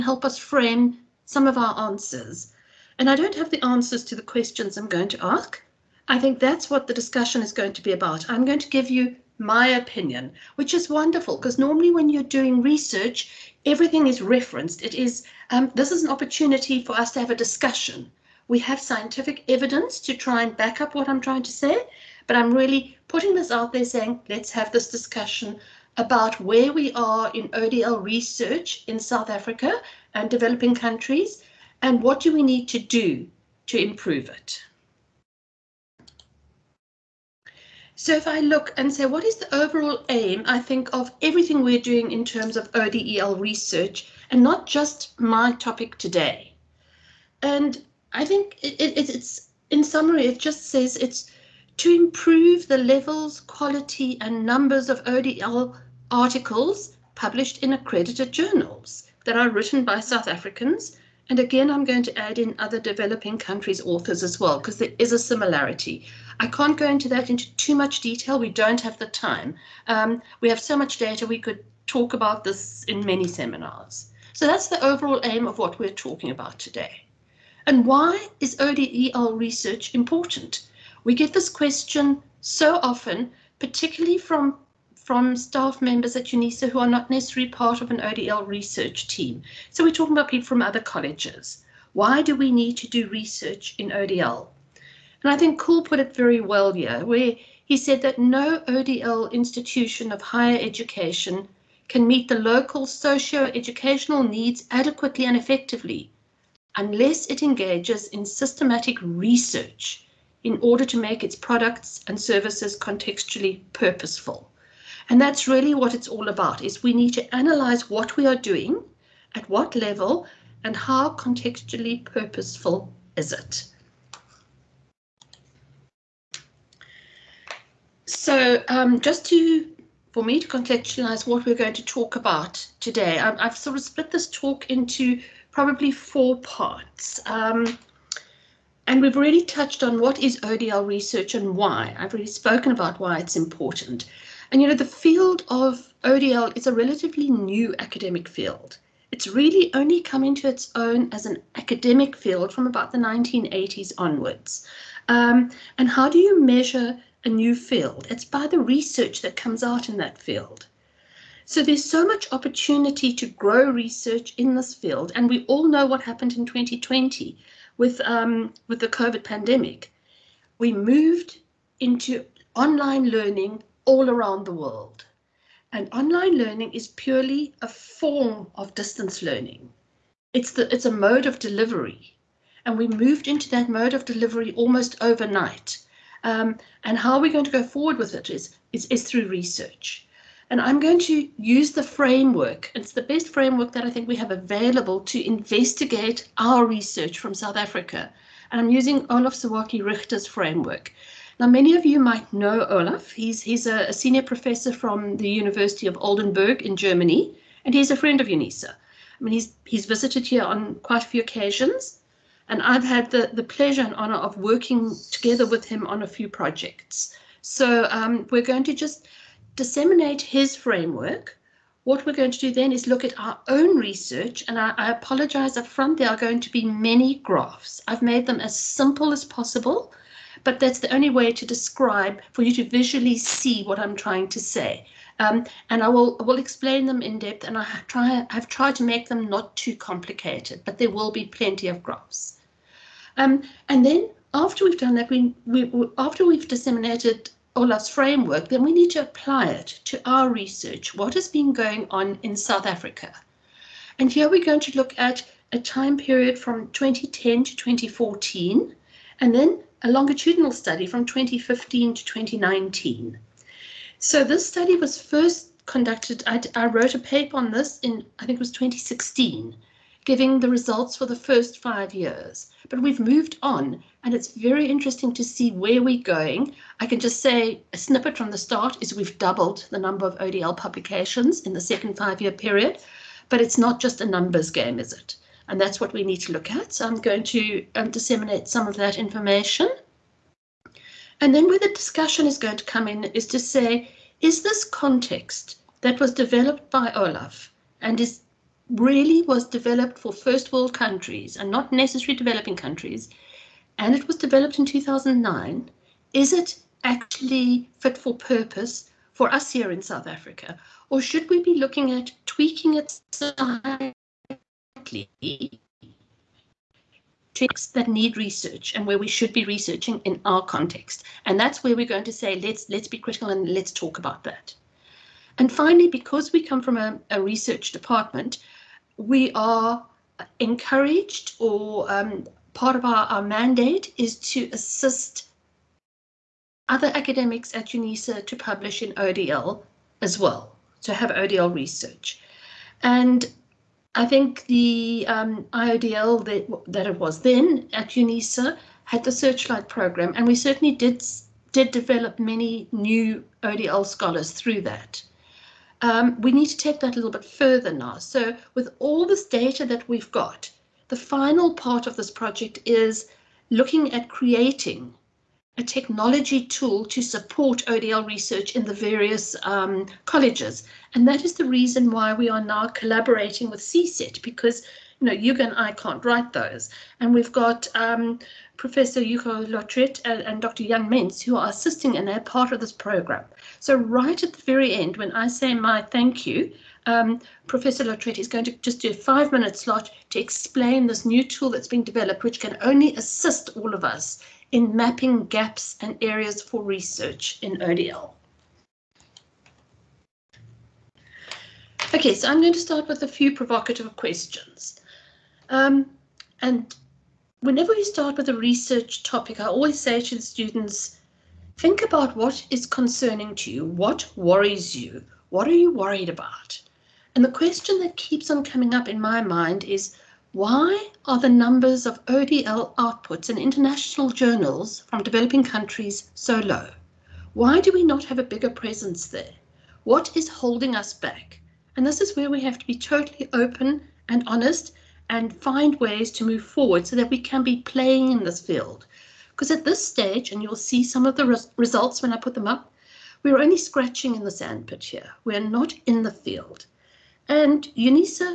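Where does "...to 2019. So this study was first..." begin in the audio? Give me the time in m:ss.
4:21.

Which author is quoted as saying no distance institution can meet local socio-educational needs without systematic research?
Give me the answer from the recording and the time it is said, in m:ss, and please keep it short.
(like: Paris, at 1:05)
Koul, at 1:35.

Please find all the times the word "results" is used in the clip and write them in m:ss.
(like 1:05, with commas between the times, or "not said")
4:30, 7:21.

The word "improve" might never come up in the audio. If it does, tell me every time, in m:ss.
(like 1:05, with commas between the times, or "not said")
0:33, 0:51.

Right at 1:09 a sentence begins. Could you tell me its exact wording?
Um, we have so much data, we could talk about this in many seminars.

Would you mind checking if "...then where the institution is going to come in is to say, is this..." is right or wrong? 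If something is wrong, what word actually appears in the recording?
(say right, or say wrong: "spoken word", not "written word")
wrong: "discussion", not "institution".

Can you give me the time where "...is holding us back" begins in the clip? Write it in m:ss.
7:10.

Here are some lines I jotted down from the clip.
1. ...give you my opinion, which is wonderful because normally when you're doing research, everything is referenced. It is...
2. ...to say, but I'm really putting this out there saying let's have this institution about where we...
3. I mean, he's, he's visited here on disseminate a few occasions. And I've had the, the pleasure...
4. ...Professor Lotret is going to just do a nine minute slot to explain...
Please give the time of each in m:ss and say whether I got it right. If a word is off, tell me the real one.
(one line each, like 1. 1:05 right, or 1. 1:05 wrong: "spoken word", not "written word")
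1. 0:08 right
2. 0:21 wrong: "discussion", not "institution"
3. 3:28 wrong: "quite", not "disseminate"
4. 6:27 wrong: "five", not "nine".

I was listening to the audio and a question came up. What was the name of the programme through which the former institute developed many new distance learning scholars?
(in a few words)
Searchlight.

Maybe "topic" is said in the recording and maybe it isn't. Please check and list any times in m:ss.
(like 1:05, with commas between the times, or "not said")
0:45, 5:17, 6:49.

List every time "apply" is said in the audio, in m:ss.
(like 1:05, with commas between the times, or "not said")
4:09.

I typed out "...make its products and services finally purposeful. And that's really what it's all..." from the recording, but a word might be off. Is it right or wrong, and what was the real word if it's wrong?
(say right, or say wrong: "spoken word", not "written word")
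wrong: "contextually", not "finally".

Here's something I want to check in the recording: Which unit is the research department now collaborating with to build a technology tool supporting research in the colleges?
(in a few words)
CSET.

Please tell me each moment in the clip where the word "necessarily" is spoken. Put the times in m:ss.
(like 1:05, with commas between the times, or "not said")
1:27, 5:01.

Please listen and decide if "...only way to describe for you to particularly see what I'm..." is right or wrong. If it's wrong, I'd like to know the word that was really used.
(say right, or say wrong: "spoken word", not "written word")
wrong: "visually", not "particularly".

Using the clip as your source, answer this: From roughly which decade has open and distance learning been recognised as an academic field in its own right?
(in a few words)
1980s.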